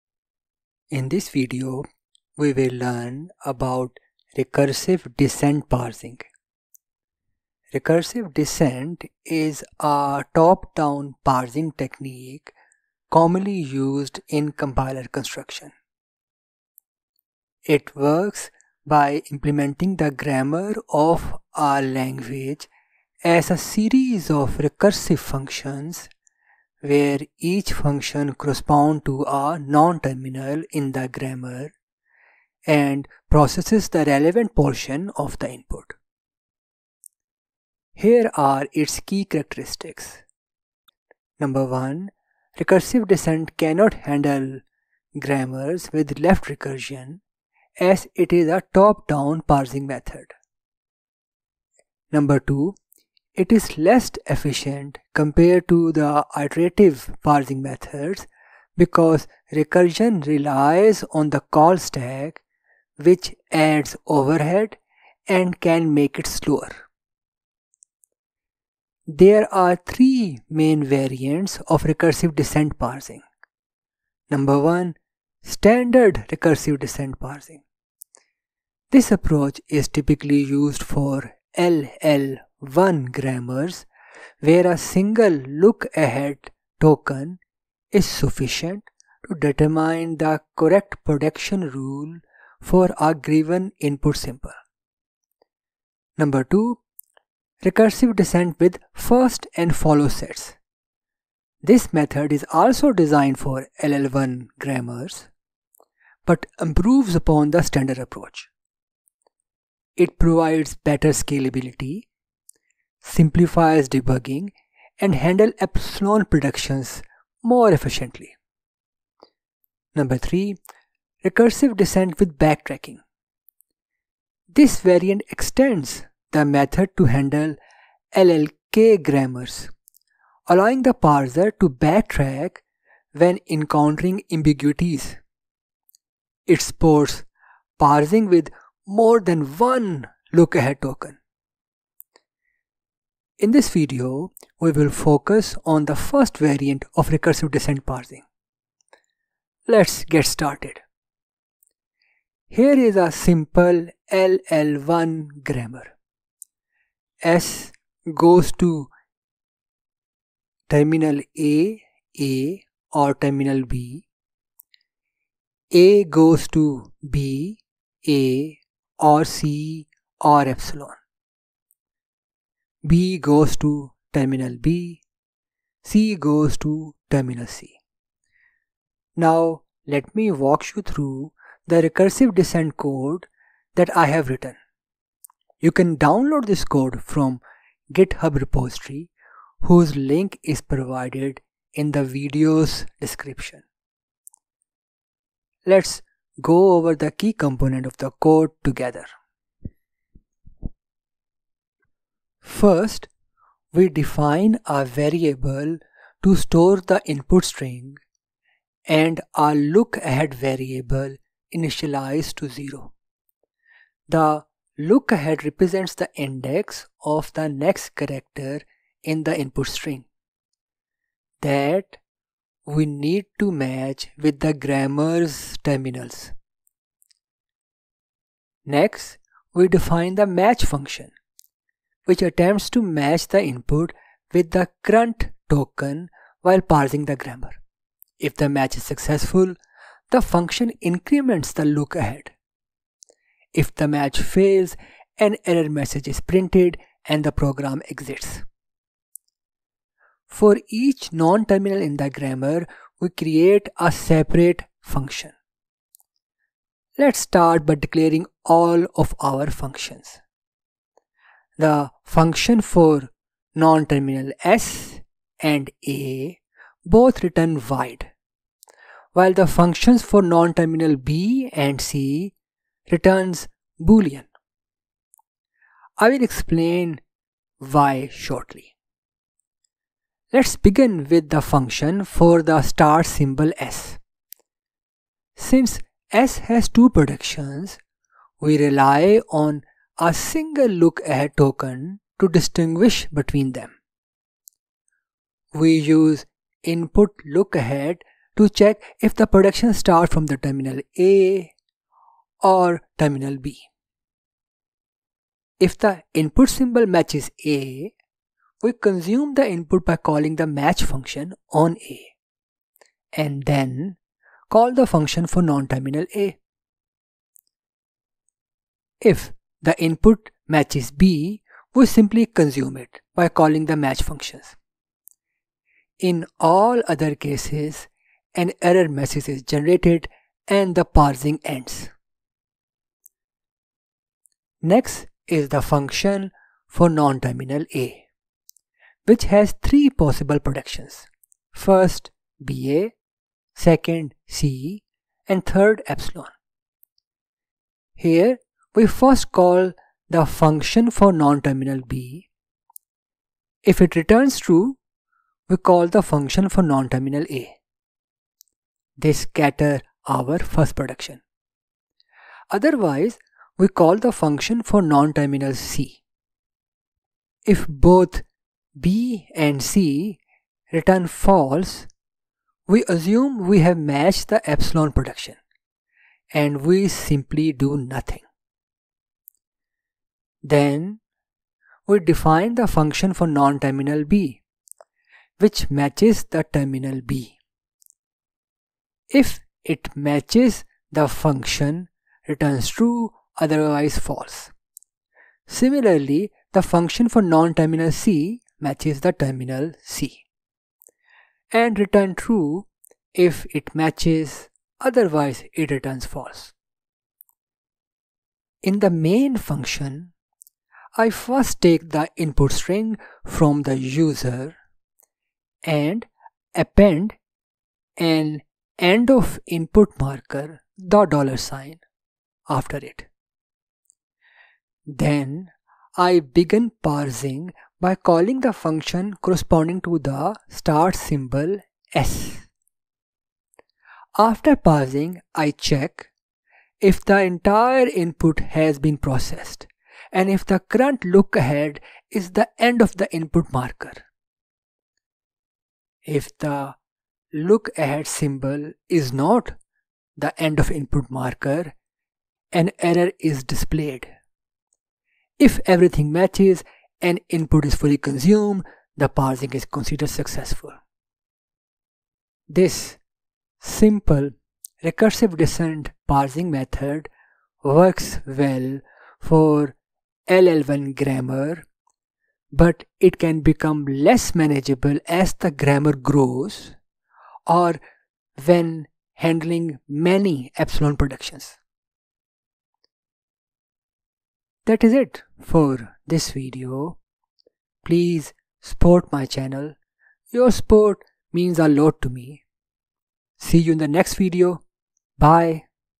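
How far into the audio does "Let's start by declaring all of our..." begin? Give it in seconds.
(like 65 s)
256 s.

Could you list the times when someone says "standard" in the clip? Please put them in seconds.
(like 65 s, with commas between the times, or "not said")
75 s, 107 s.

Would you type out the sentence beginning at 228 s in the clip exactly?
Next, we define the match function which attempts to match the input with the current token while parsing the grammar.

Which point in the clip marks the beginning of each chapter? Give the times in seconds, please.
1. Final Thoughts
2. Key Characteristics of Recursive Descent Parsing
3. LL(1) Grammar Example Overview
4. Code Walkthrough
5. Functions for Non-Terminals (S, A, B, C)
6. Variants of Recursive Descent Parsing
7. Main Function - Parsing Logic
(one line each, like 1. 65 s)
1. 461 s
2. 37 s
3. 150 s
4. 179 s
5. 253 s
6. 68 s
7. 406 s.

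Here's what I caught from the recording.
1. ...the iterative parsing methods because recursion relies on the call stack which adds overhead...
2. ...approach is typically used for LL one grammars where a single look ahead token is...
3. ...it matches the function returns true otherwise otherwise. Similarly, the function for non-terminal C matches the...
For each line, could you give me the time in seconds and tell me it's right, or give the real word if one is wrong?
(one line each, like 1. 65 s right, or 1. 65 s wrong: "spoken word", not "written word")
1. 55 s right
2. 79 s right
3. 389 s wrong: "false", not "otherwise".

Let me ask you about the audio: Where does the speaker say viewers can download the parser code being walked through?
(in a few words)
GitHub repository.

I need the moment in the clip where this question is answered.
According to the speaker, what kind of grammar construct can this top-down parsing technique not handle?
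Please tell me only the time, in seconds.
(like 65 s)
46 s.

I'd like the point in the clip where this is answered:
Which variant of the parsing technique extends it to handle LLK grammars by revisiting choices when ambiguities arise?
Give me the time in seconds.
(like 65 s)
121 s.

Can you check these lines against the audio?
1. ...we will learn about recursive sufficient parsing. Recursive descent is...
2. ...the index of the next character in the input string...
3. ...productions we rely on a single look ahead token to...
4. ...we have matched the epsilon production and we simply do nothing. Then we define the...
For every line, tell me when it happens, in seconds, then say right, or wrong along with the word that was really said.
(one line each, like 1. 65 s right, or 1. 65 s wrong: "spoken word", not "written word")
1. 2 s wrong: "descent", not "sufficient"
2. 215 s right
3. 286 s right
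4. 373 s right.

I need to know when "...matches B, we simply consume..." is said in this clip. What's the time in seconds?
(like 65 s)
320 s.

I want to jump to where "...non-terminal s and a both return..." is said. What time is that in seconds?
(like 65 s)
263 s.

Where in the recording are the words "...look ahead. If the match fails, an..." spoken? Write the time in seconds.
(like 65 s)
241 s.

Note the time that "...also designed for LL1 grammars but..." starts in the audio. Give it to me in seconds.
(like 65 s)
102 s.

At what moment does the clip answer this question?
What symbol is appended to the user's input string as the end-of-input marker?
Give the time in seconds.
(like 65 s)
421 s.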